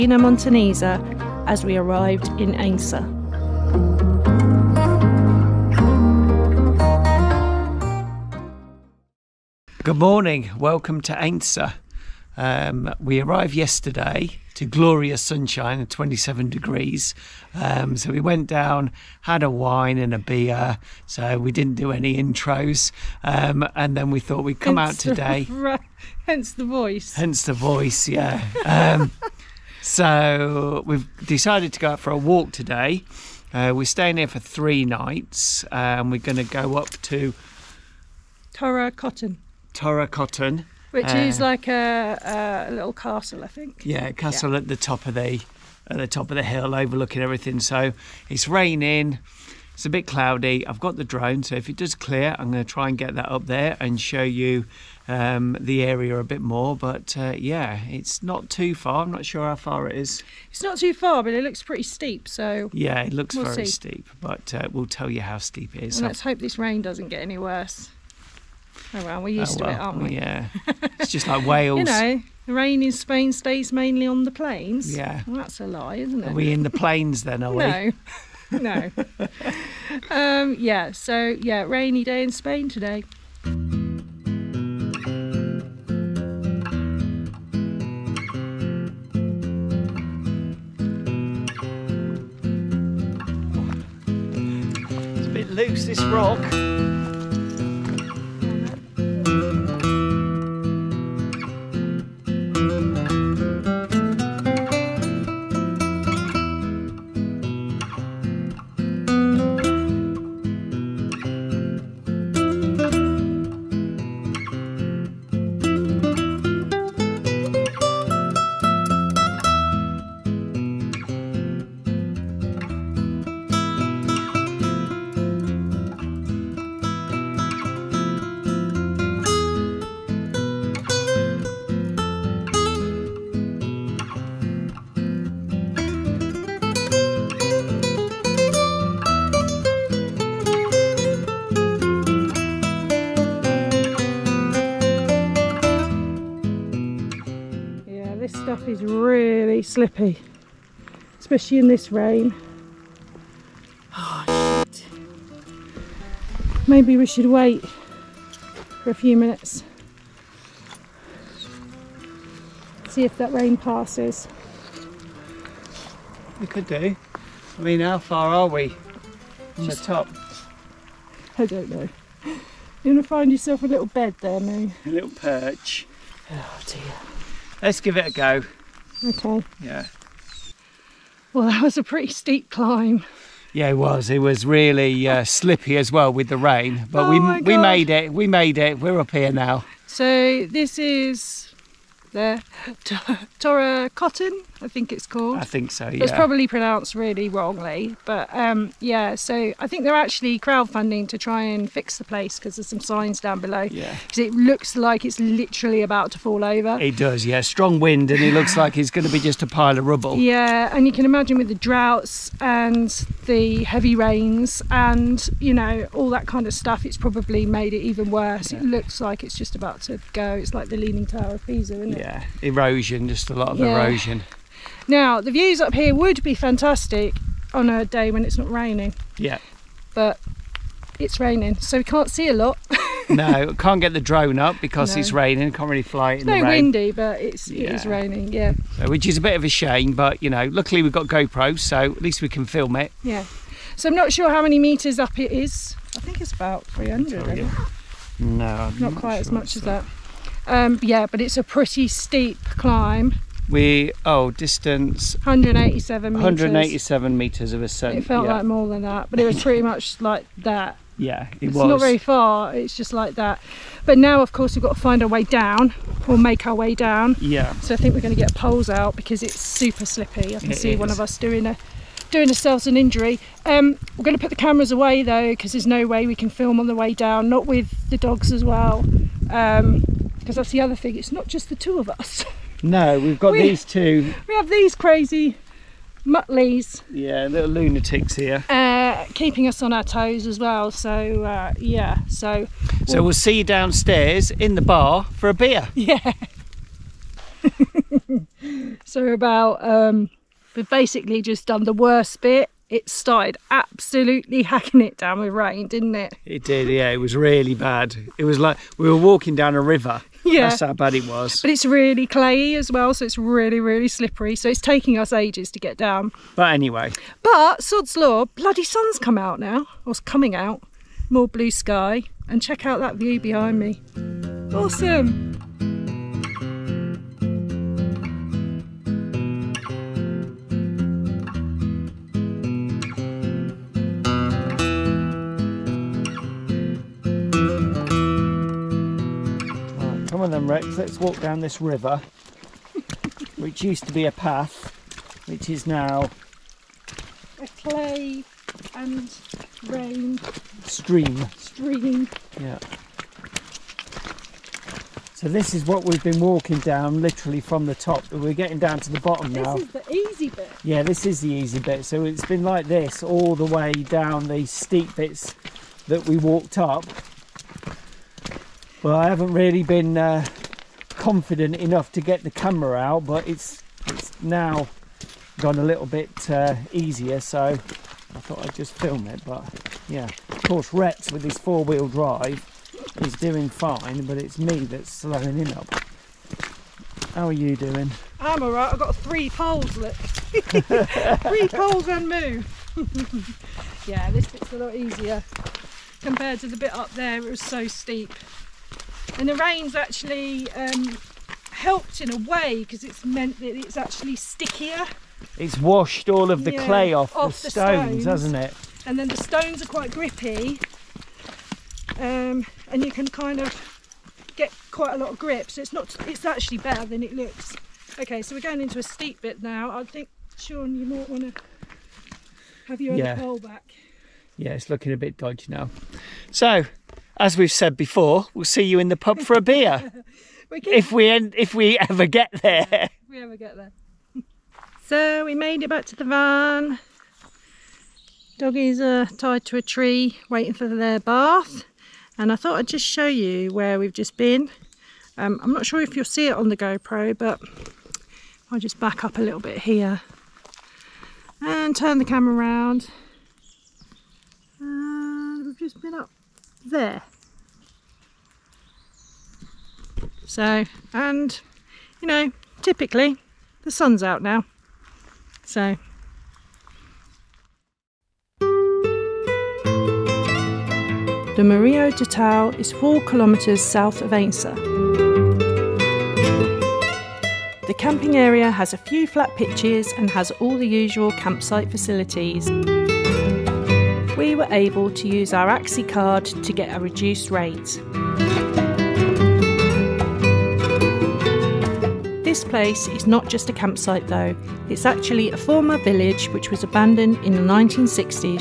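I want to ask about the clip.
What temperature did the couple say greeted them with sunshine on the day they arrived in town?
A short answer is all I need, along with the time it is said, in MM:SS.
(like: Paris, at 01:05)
27 degrees, at 00:15.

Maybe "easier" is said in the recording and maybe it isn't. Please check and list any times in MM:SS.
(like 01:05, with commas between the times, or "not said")
06:16, 06:34.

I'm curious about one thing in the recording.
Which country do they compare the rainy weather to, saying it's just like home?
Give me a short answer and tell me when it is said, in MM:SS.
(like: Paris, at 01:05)
Wales, at 01:11.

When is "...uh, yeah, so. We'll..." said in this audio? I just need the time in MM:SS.
04:51.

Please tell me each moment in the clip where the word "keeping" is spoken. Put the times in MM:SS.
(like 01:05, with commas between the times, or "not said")
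04:49.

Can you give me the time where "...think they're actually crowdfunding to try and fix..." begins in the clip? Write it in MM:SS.
03:19.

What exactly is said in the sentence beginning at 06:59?
I think Shaun, you might want to have your yeah.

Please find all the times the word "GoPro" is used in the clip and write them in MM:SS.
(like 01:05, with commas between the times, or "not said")
04:01, 07:26.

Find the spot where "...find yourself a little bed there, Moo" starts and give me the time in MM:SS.
02:53.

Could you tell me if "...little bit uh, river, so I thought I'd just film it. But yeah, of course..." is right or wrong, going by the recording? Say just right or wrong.
wrong.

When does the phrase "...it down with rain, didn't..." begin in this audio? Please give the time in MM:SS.
05:04.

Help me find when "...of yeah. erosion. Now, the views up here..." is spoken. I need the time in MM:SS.
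03:43.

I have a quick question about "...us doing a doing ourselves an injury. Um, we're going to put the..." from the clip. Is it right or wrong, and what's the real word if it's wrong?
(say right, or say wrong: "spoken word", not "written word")
right.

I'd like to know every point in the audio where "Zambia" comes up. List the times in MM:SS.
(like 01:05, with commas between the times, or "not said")
not said.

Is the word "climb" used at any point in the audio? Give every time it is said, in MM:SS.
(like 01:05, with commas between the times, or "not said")
03:02, 04:12.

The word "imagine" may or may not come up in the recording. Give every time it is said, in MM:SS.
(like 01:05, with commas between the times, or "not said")
03:31.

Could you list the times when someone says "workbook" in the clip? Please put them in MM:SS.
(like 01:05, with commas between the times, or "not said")
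not said.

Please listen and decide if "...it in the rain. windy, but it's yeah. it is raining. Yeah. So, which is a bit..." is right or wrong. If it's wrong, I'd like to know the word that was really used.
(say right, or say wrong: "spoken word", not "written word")
right.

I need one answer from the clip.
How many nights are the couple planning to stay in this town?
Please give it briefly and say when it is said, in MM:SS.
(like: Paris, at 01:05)
3, at 00:34.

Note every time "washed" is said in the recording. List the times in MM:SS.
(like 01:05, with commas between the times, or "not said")
06:45.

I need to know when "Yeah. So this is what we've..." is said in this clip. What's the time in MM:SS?
05:52.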